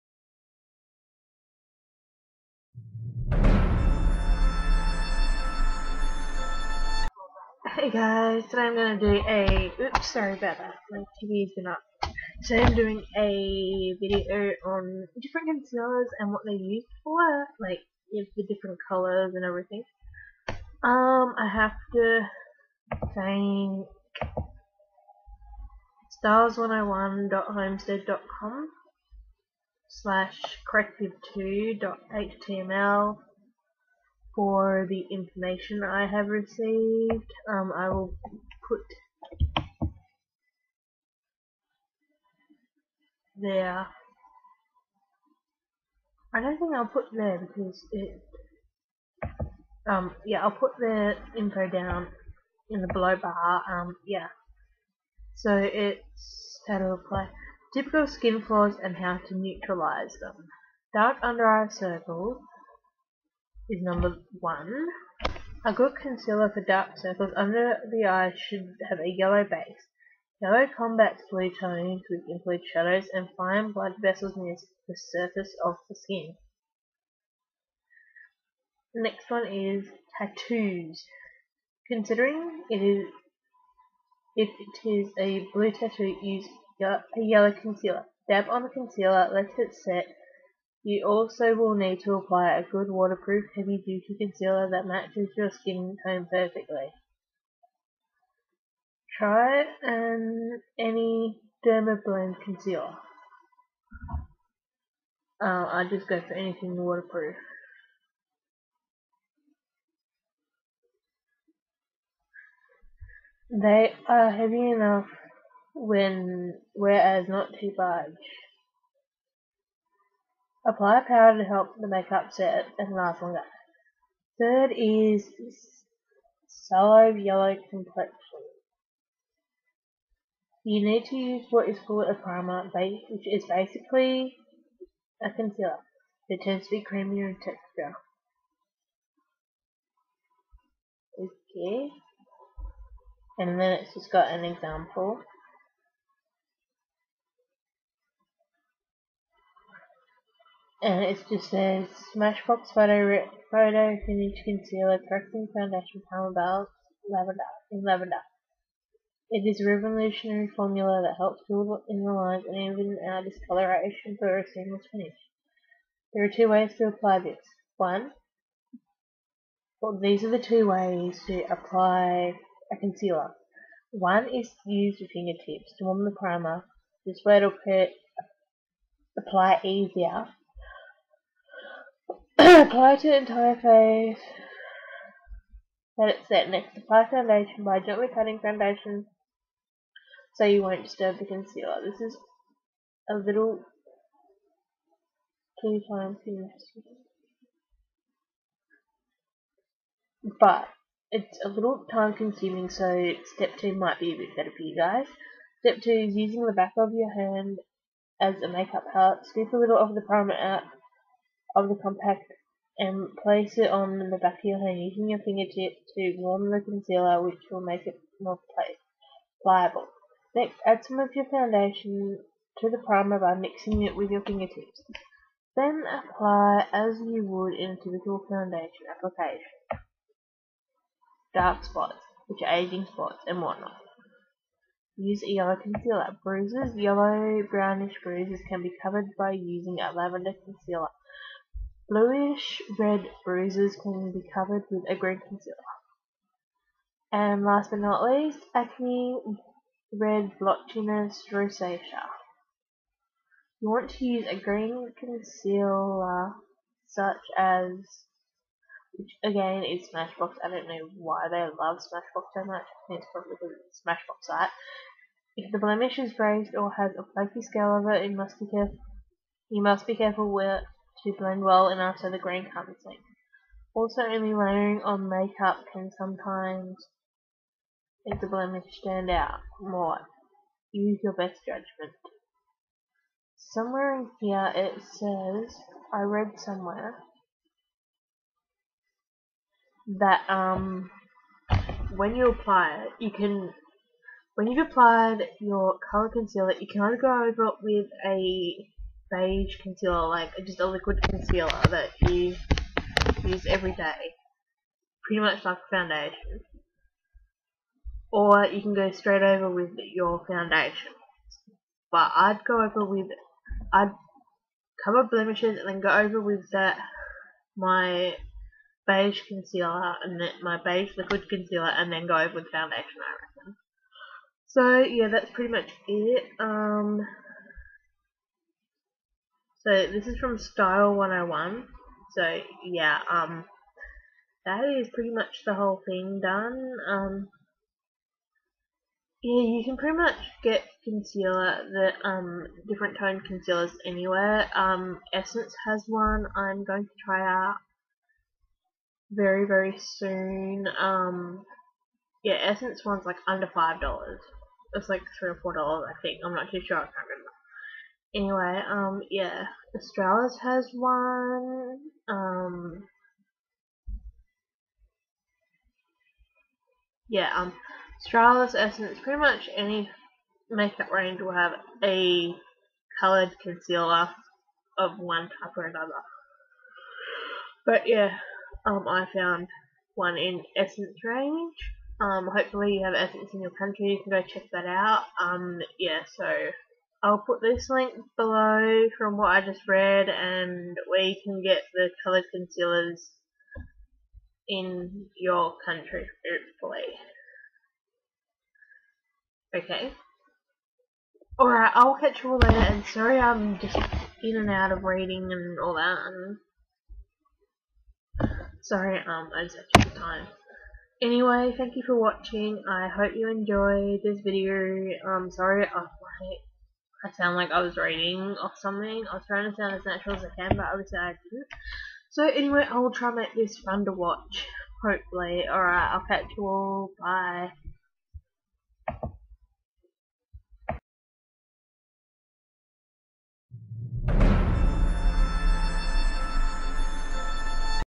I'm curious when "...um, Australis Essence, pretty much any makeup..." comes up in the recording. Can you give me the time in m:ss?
6:07.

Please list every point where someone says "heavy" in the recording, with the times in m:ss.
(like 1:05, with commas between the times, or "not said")
1:33, 1:54.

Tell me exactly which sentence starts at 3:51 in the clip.
Dark spots, which are aging spots and whatnot.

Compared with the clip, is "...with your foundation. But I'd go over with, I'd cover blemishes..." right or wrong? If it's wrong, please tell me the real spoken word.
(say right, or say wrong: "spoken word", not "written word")
right.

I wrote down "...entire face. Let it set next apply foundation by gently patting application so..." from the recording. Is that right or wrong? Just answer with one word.
wrong.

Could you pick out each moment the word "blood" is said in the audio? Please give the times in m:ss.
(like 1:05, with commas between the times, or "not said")
1:13.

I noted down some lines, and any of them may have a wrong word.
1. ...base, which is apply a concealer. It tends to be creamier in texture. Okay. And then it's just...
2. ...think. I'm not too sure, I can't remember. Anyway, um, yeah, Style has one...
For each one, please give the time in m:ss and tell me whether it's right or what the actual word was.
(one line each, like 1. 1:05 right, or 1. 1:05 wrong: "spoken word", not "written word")
1. 2:12 wrong: "basically", not "apply"
2. 5:56 wrong: "Australis", not "Style".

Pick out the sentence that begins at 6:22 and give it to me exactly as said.
Um, hopefully you have Essence in your country, you can go check that out.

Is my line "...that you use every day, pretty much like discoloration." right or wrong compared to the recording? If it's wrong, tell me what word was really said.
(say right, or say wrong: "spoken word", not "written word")
wrong: "foundation", not "discoloration".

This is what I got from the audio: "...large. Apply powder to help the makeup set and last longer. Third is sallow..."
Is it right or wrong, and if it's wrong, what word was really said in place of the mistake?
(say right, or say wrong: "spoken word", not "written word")
right.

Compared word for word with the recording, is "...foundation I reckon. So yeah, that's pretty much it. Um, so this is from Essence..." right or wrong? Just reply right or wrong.
wrong.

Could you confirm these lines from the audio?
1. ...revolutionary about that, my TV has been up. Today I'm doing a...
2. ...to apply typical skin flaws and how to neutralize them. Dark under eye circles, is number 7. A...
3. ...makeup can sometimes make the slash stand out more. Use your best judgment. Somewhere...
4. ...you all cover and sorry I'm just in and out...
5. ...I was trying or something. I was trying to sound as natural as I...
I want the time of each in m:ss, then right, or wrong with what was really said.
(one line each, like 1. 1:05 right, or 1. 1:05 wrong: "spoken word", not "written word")
1. 0:10 wrong: "sorry", not "revolutionary"
2. 0:56 wrong: "1", not "7"
3. 4:35 wrong: "blemish", not "slash"
4. 6:42 wrong: "later", not "cover"
5. 6:57 wrong: "reading", not "trying".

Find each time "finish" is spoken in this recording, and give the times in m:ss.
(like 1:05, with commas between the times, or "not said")
2:34, 2:44.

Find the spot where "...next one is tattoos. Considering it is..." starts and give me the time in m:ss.
1:19.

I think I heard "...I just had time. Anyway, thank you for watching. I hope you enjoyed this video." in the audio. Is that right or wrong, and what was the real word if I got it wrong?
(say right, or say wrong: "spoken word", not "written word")
right.